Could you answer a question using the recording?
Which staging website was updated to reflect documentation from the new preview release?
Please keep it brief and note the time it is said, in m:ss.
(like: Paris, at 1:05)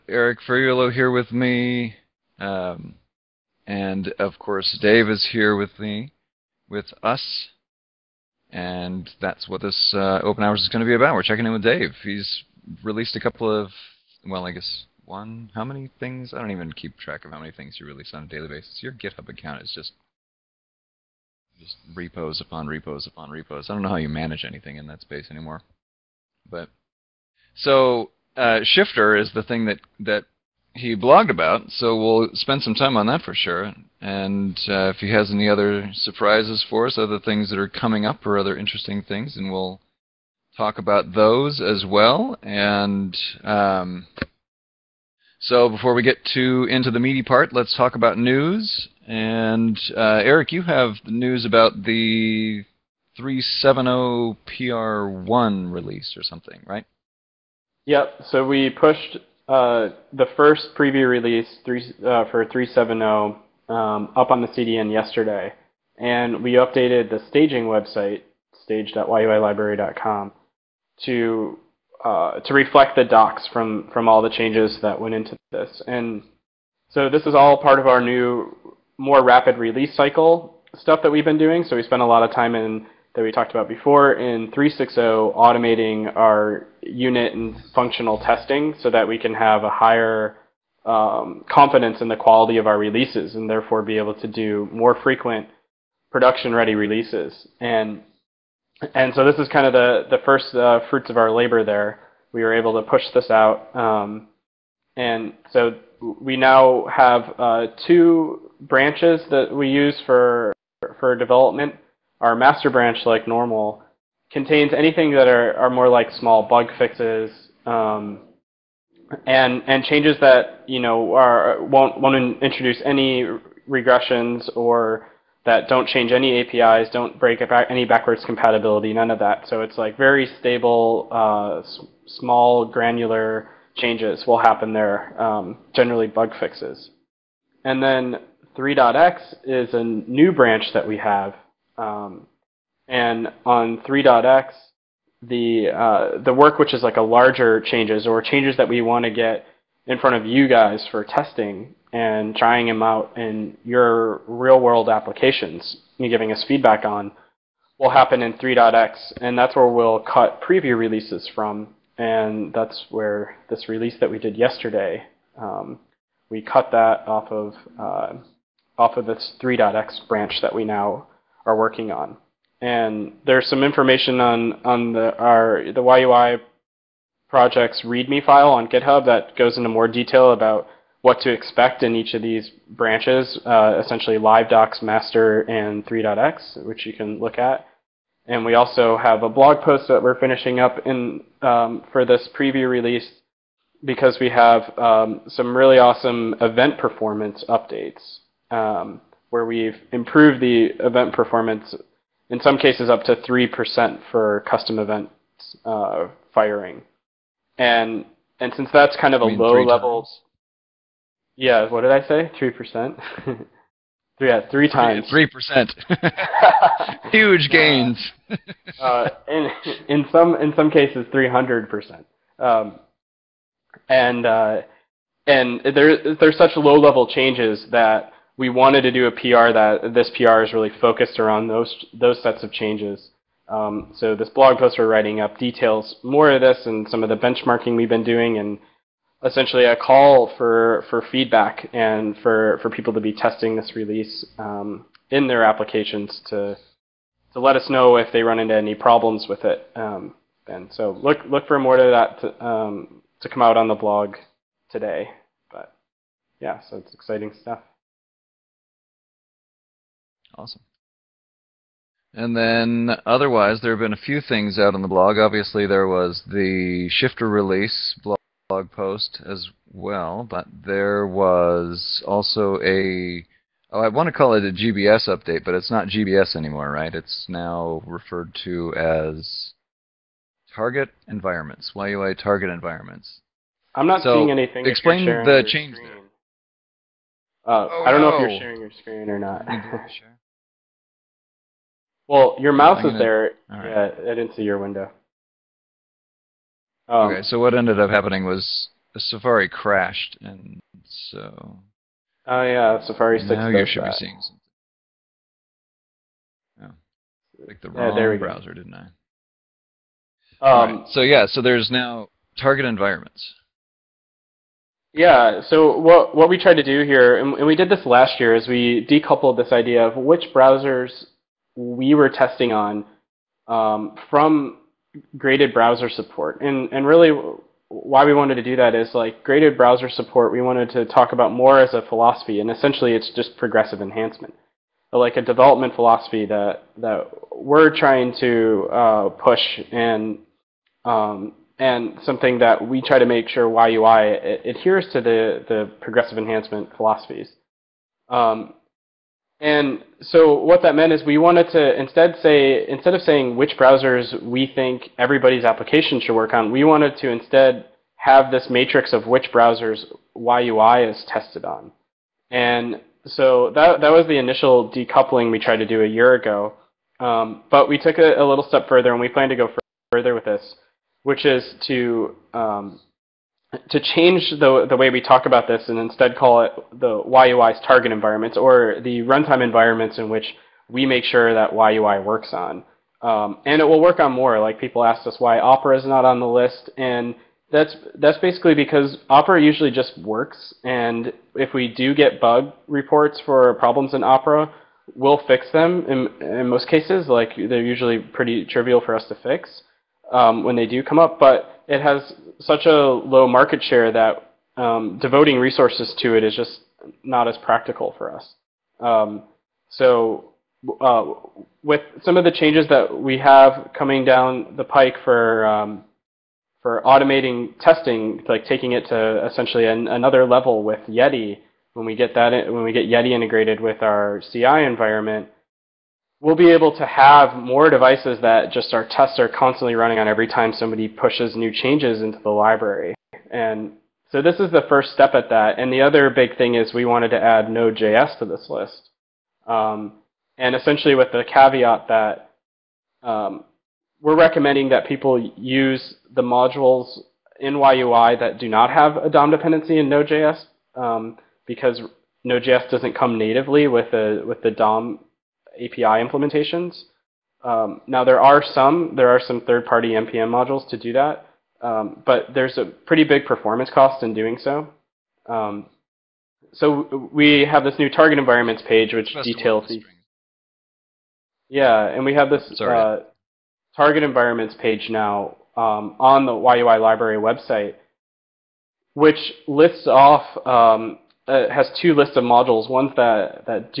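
stage.yuilibrary.com, at 1:08.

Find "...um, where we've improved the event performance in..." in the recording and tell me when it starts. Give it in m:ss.
3:18.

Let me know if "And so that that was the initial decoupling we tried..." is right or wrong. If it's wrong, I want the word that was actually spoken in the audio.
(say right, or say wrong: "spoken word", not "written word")
right.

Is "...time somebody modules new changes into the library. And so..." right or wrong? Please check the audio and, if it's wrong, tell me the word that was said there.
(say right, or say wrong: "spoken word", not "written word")
wrong: "pushes", not "modules".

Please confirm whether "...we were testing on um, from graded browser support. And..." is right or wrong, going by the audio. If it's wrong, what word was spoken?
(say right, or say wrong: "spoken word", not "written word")
right.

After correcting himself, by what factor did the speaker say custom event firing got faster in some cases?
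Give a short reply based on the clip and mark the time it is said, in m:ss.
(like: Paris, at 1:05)
three times, at 3:34.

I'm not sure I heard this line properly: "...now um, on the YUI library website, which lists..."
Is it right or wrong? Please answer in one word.
right.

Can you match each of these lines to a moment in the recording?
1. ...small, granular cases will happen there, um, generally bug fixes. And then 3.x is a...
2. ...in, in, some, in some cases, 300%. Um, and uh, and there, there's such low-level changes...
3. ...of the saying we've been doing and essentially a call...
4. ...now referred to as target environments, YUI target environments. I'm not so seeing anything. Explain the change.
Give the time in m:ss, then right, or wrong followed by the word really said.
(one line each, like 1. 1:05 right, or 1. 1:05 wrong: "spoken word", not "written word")
1. 2:12 wrong: "changes", not "cases"
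2. 3:39 right
3. 3:57 wrong: "benchmarking", not "saying"
4. 4:37 right.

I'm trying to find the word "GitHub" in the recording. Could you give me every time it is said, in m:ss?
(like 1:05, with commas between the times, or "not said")
0:18, 2:58.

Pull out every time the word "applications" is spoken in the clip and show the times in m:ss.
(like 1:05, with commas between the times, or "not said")
2:34, 4:05, 5:55.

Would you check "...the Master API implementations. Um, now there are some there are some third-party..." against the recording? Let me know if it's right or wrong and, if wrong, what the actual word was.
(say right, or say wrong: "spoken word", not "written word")
wrong: "DOM", not "Master".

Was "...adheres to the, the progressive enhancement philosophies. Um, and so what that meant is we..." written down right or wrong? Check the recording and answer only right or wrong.
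right.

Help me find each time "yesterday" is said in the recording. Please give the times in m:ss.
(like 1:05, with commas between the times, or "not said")
1:04, 2:44.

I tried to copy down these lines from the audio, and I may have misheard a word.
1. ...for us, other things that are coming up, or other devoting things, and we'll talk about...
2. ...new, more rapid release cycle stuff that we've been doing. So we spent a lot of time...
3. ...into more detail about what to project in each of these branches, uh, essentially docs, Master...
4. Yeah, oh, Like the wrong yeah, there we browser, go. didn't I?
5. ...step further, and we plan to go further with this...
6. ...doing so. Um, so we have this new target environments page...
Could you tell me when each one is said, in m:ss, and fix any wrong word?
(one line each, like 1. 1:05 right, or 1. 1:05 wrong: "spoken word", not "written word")
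1. 0:36 wrong: "interesting", not "devoting"
2. 1:17 right
3. 2:59 wrong: "expect", not "project"
4. 5:06 right
5. 6:08 right
6. 7:44 right.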